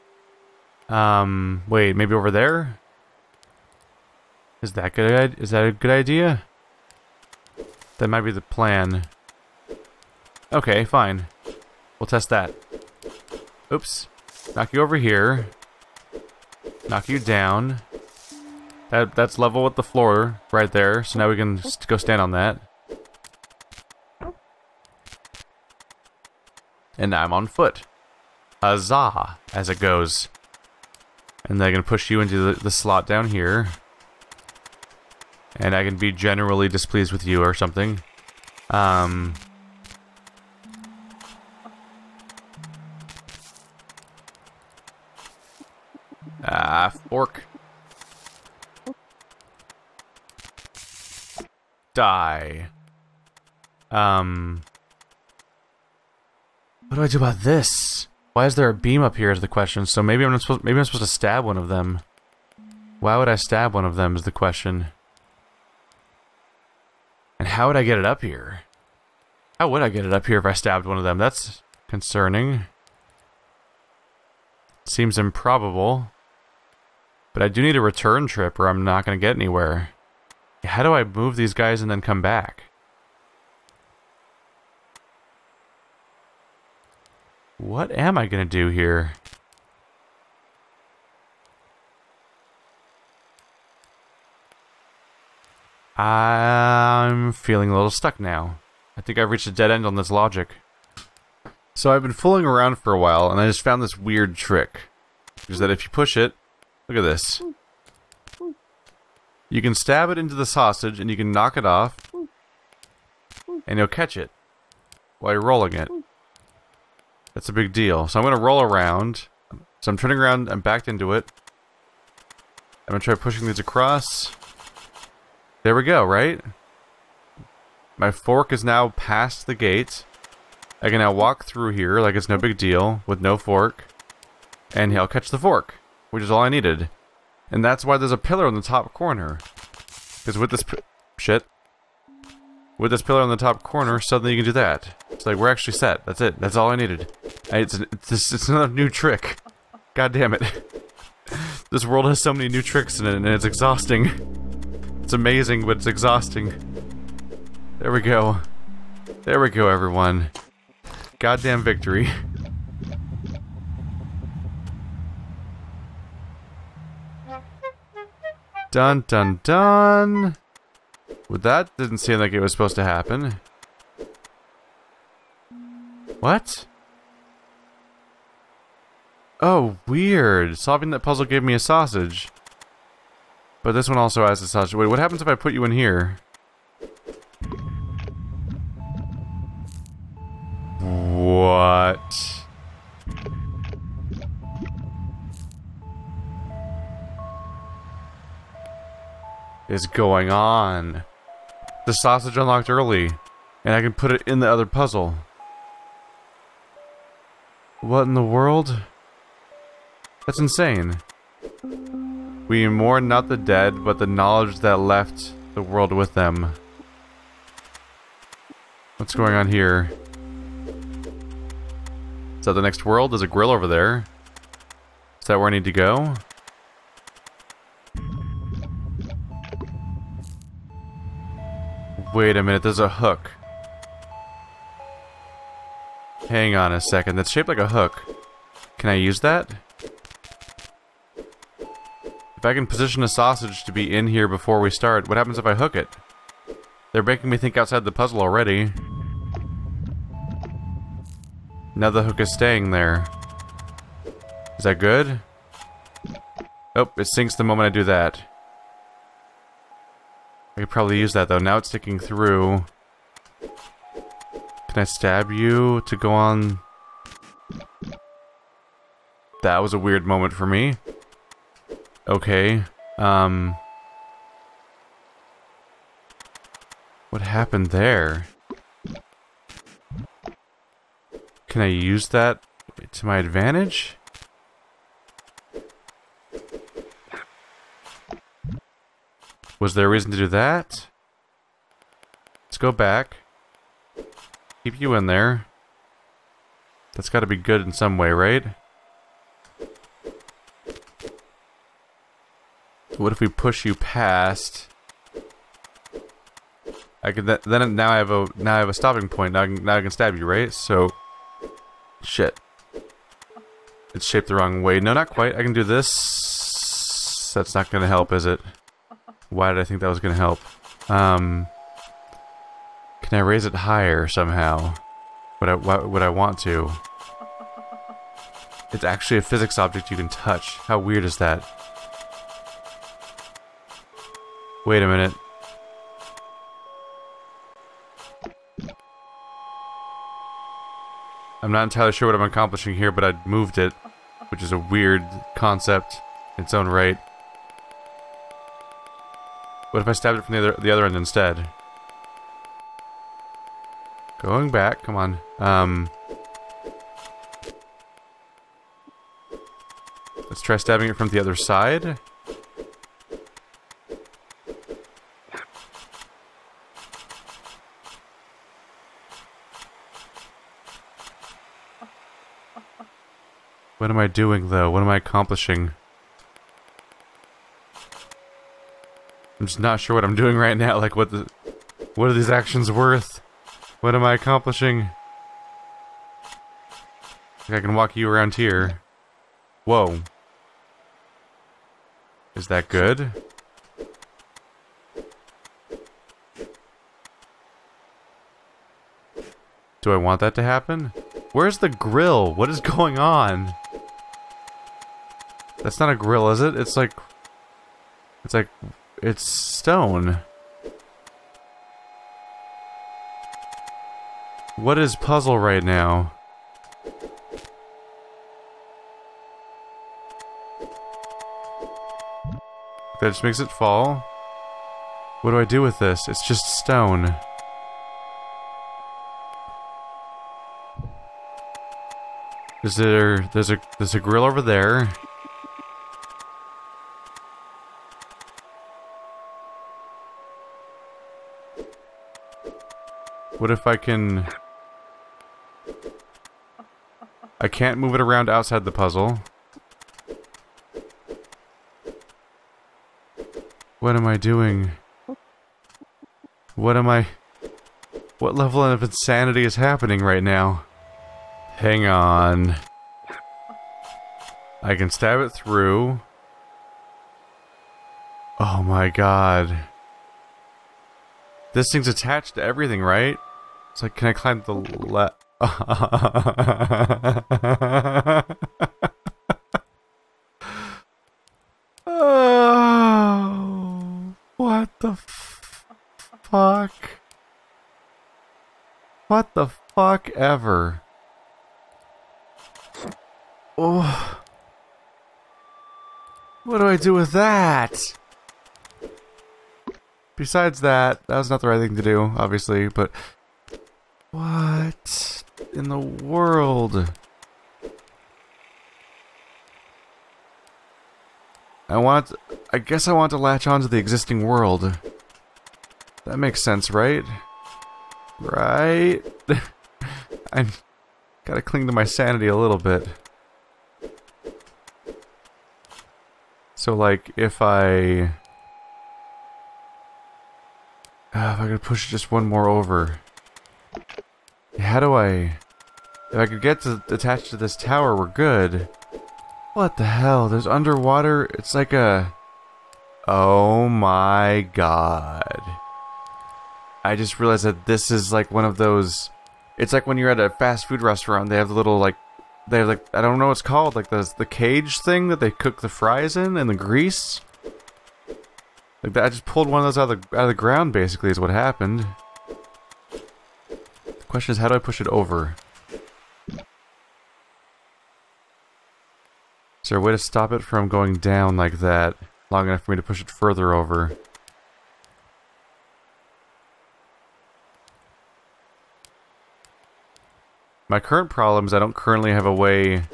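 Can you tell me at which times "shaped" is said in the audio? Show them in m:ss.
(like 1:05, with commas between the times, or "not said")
3:57, 5:14.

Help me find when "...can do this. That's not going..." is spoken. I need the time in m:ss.
5:15.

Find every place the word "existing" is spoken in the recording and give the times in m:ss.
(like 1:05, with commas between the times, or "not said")
8:33.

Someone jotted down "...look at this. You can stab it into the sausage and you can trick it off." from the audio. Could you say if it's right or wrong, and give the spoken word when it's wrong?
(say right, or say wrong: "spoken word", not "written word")
wrong: "knock", not "trick".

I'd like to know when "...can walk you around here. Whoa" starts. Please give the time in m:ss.
6:27.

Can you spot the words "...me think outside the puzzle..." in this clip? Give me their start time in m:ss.
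4:07.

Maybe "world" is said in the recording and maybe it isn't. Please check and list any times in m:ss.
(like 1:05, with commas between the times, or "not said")
2:31, 3:28, 3:35, 3:42, 8:25, 8:34.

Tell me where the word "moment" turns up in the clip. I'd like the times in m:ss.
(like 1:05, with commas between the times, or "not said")
4:17, 4:30.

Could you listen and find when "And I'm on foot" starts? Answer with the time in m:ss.
0:26.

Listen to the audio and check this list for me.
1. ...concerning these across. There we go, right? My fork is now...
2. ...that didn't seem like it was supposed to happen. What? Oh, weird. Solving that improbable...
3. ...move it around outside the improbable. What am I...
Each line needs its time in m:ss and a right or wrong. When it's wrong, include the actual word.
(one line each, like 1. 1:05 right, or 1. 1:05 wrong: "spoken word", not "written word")
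1. 2:03 wrong: "pushing", not "concerning"
2. 2:51 wrong: "puzzle", not "improbable"
3. 7:27 wrong: "puzzle", not "improbable".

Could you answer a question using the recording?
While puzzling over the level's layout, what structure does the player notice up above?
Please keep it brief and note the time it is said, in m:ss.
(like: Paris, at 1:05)
A beam, at 0:58.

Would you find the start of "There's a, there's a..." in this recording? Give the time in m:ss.
7:13.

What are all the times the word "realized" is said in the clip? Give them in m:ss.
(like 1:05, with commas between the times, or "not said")
9:07.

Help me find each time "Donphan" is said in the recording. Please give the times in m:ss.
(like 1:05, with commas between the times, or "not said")
not said.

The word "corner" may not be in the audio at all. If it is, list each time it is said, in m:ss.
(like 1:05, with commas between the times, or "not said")
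2:18, 2:23.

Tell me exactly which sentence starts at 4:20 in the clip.
I could probably use that, though.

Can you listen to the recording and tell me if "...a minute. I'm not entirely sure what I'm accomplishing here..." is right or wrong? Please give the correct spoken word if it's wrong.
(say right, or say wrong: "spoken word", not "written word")
right.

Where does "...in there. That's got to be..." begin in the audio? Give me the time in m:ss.
4:54.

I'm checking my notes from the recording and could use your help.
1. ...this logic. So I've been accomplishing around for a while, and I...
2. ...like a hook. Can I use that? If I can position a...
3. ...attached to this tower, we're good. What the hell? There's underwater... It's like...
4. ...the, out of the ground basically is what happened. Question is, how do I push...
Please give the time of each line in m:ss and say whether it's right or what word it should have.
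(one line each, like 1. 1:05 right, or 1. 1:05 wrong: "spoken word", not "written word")
1. 1:39 wrong: "fooling", not "accomplishing"
2. 3:57 right
3. 8:56 right
4. 9:20 right.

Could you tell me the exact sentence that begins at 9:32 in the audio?
Long enough for me to push it further over.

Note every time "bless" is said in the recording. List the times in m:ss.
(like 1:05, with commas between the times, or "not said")
not said.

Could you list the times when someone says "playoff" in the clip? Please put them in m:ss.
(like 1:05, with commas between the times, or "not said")
not said.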